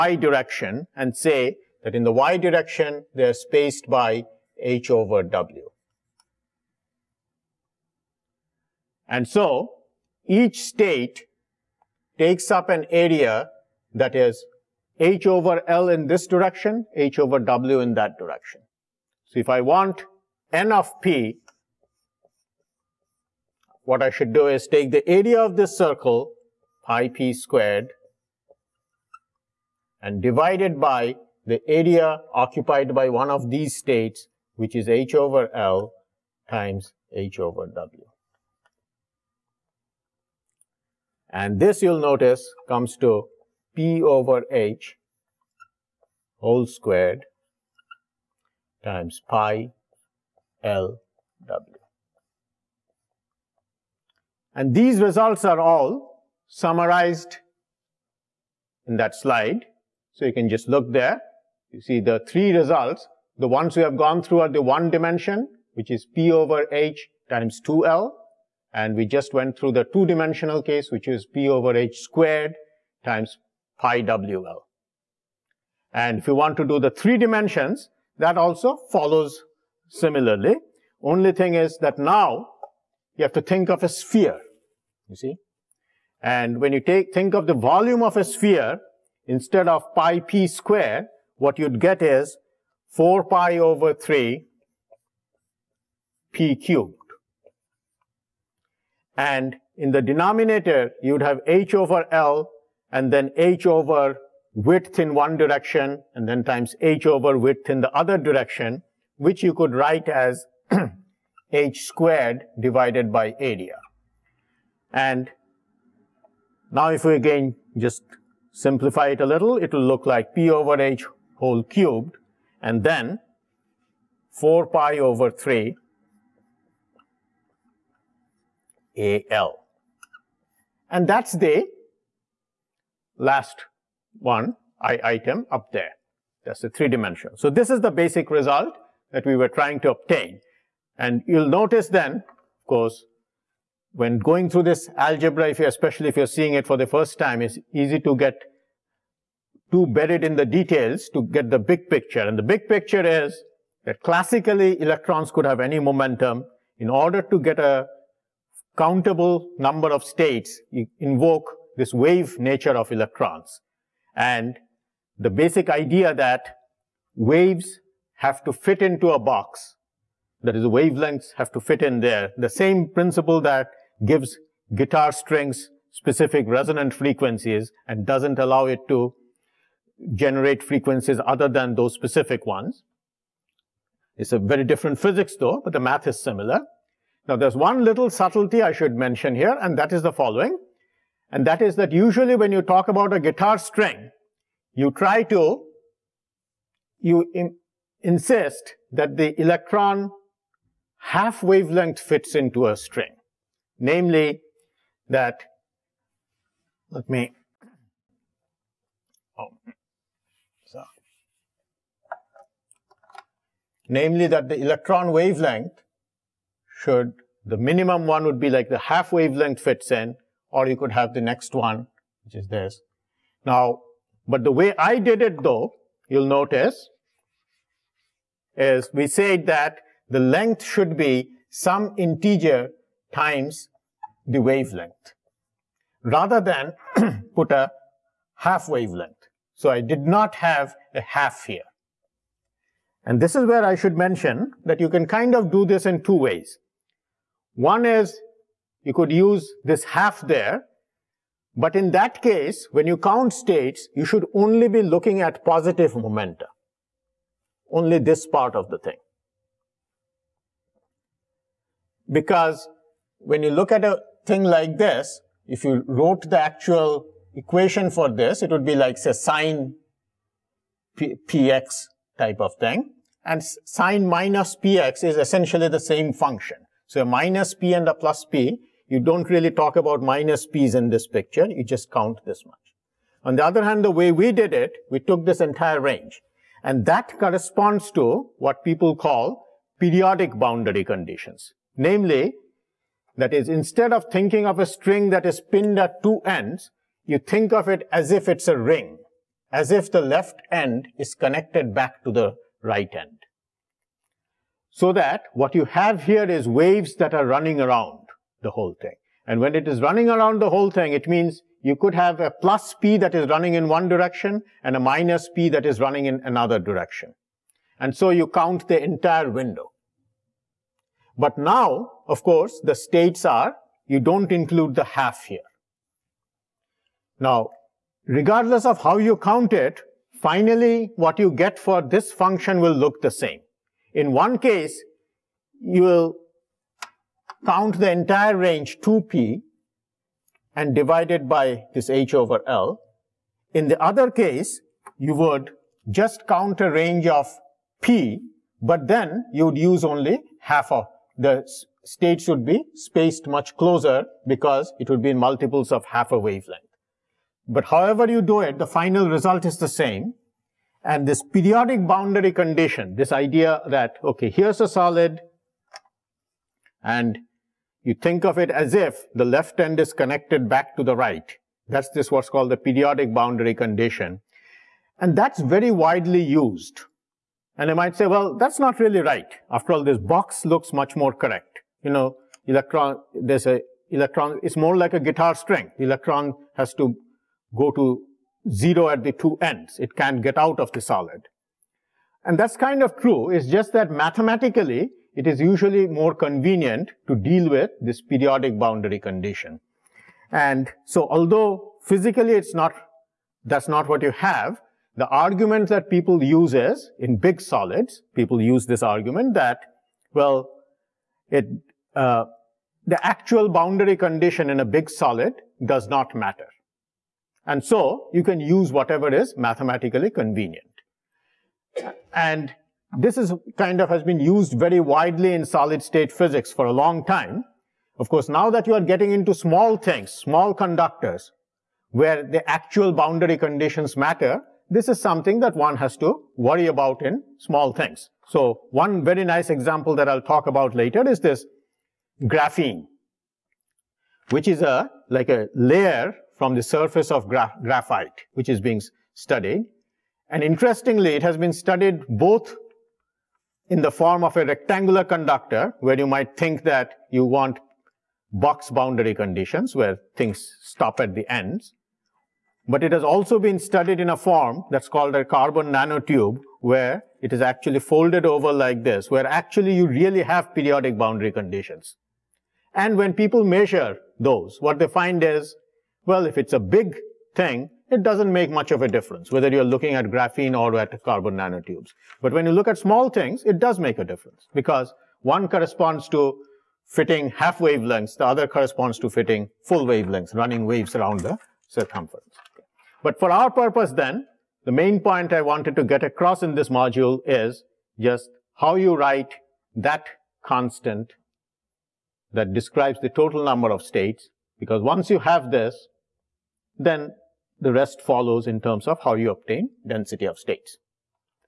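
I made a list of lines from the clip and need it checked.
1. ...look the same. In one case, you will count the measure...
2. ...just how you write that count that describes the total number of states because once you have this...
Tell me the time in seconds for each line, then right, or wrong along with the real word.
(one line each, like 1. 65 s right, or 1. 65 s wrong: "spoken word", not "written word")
1. 332 s wrong: "entire", not "measure"
2. 497 s wrong: "constant", not "count".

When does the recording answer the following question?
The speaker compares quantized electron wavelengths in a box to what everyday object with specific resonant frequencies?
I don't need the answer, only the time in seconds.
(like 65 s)
174 s.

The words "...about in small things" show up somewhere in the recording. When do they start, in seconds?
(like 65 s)
436 s.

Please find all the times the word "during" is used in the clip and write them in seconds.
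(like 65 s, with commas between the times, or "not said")
not said.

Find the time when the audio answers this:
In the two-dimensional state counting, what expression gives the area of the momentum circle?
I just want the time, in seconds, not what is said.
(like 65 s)
26 s.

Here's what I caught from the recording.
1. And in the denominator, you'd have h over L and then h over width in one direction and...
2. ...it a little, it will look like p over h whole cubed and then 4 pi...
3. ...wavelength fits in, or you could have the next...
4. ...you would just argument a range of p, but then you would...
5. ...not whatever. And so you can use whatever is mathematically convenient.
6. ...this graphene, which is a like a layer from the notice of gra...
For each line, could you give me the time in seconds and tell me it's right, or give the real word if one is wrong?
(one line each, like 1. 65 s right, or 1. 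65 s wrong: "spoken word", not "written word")
1. 99 s right
2. 119 s right
3. 219 s right
4. 344 s wrong: "count", not "argument"
5. 415 s wrong: "matter", not "whatever"
6. 441 s wrong: "surface", not "notice".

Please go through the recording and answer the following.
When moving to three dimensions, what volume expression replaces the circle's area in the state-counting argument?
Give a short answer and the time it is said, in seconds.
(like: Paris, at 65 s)
4 pi over 3 p cubed, at 92 s.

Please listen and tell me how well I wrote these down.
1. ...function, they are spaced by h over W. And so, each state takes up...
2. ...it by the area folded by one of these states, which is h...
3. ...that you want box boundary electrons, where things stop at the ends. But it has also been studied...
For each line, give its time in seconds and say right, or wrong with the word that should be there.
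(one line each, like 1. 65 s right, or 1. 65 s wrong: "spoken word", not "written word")
1. 2 s wrong: "direction", not "function"
2. 30 s wrong: "occupied", not "folded"
3. 456 s wrong: "conditions", not "electrons".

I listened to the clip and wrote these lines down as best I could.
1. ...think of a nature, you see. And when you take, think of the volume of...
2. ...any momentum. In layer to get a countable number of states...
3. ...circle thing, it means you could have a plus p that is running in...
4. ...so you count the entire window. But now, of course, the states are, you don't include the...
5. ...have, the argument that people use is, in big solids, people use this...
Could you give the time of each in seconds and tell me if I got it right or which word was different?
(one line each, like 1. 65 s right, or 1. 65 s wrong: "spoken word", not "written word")
1. 83 s wrong: "sphere", not "nature"
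2. 155 s wrong: "order", not "layer"
3. 310 s wrong: "whole", not "circle"
4. 317 s right
5. 404 s right.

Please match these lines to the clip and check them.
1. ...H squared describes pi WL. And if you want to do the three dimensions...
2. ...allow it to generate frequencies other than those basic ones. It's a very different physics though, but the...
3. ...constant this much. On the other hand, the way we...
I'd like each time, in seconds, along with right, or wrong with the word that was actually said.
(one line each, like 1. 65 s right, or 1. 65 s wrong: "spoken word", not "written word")
1. 71 s wrong: "times", not "describes"
2. 178 s wrong: "specific", not "basic"
3. 281 s wrong: "count", not "constant".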